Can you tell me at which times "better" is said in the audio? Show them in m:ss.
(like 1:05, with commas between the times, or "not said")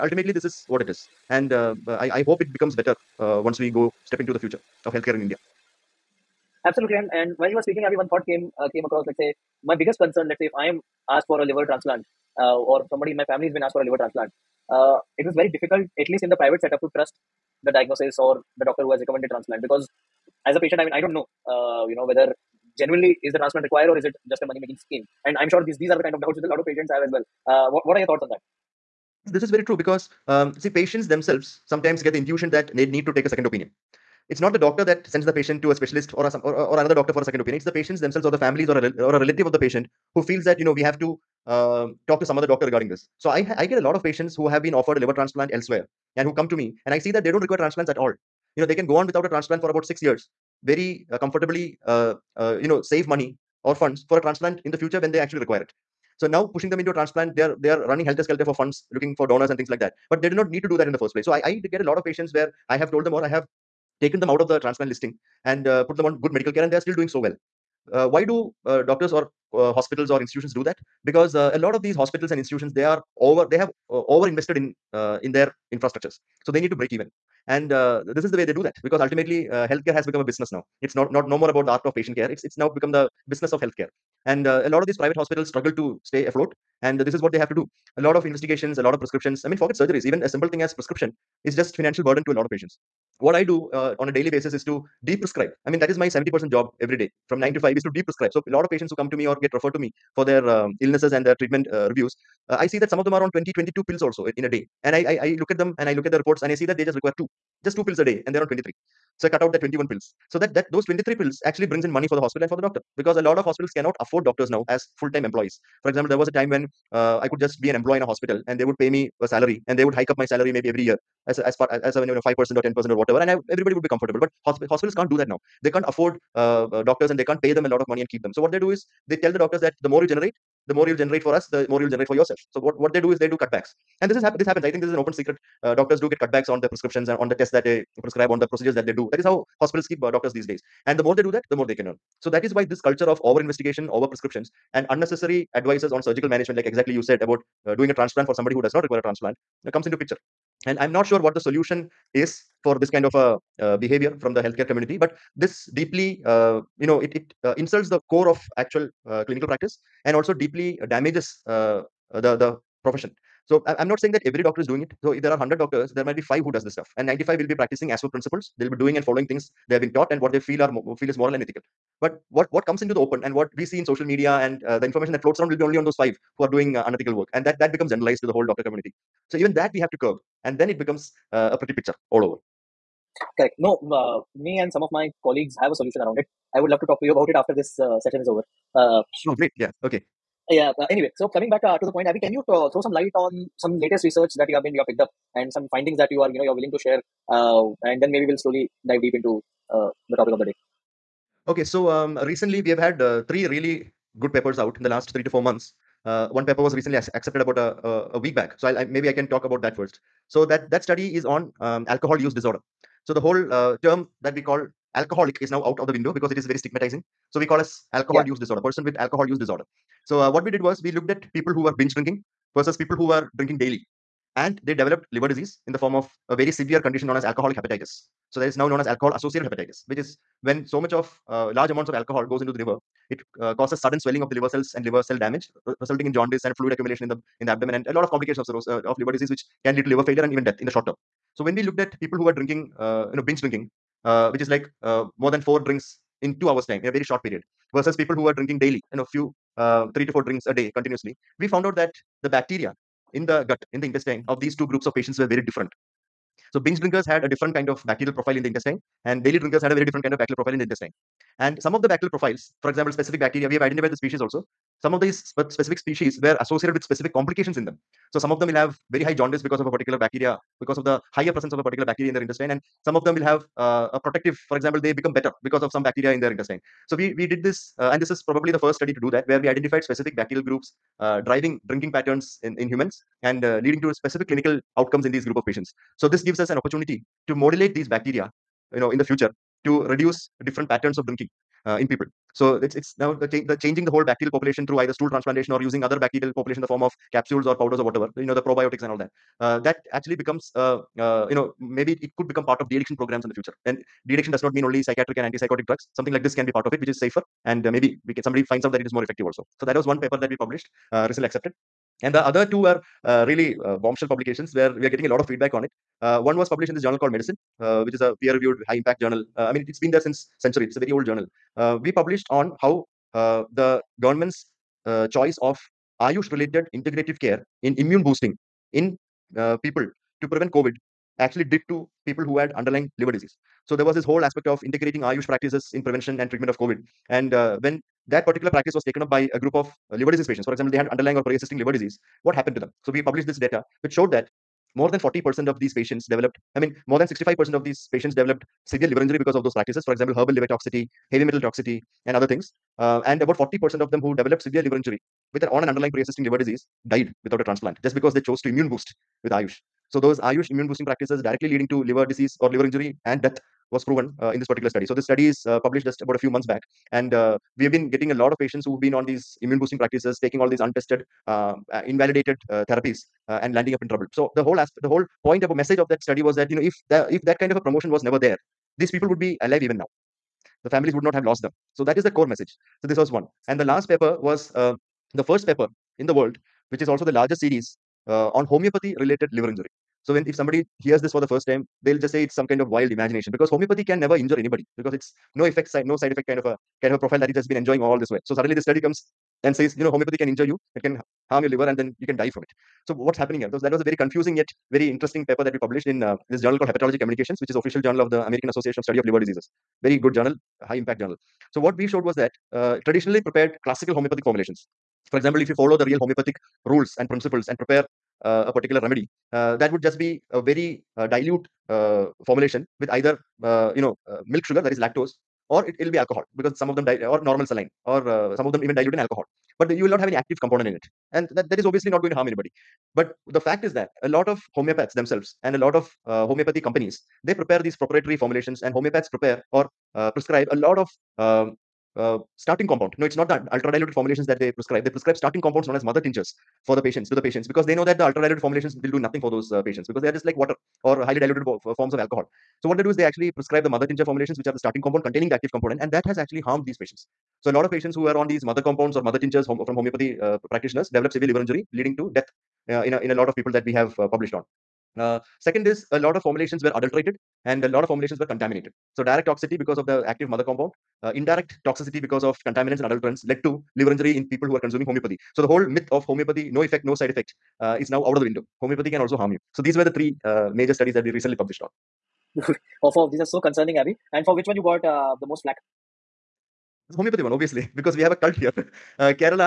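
0:02, 4:35.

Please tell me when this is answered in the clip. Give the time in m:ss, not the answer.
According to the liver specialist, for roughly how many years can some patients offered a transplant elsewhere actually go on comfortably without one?
0:49.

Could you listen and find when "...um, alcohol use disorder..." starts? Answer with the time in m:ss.
3:31.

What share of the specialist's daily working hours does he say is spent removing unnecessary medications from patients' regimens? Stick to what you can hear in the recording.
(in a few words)
70%.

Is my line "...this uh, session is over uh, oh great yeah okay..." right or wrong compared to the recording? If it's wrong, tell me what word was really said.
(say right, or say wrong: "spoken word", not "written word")
right.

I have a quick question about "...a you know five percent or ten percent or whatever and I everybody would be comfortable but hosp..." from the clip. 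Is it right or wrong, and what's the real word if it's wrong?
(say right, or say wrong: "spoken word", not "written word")
right.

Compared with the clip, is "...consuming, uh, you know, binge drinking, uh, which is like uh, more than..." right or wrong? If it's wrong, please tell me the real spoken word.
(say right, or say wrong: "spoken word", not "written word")
wrong: "drinking", not "consuming".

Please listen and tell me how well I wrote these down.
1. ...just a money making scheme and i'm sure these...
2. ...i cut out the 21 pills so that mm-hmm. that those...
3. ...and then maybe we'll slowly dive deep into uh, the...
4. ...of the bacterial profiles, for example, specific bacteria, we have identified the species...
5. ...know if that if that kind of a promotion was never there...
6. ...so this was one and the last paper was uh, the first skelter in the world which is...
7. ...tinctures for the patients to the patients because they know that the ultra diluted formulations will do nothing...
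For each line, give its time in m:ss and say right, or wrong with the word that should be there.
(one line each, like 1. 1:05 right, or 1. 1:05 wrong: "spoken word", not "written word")
1. 0:24 right
2. 1:49 right
3. 3:17 right
4. 4:21 right
5. 6:16 right
6. 6:22 wrong: "paper", not "skelter"
7. 7:25 right.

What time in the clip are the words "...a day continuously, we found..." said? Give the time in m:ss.
4:10.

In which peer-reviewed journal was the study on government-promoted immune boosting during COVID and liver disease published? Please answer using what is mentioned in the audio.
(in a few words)
Medicine.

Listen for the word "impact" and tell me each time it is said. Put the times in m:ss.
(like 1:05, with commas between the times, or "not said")
5:18, 6:50.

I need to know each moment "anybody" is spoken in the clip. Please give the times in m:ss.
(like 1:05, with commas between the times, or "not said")
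6:34, 7:12.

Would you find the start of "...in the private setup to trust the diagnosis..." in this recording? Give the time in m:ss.
0:16.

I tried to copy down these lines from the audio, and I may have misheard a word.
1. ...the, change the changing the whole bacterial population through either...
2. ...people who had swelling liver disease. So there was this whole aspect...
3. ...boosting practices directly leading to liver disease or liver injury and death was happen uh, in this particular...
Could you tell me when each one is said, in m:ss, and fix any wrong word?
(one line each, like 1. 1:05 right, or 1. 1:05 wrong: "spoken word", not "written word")
1. 4:53 right
2. 5:32 wrong: "underlying", not "swelling"
3. 6:00 wrong: "proven", not "happen".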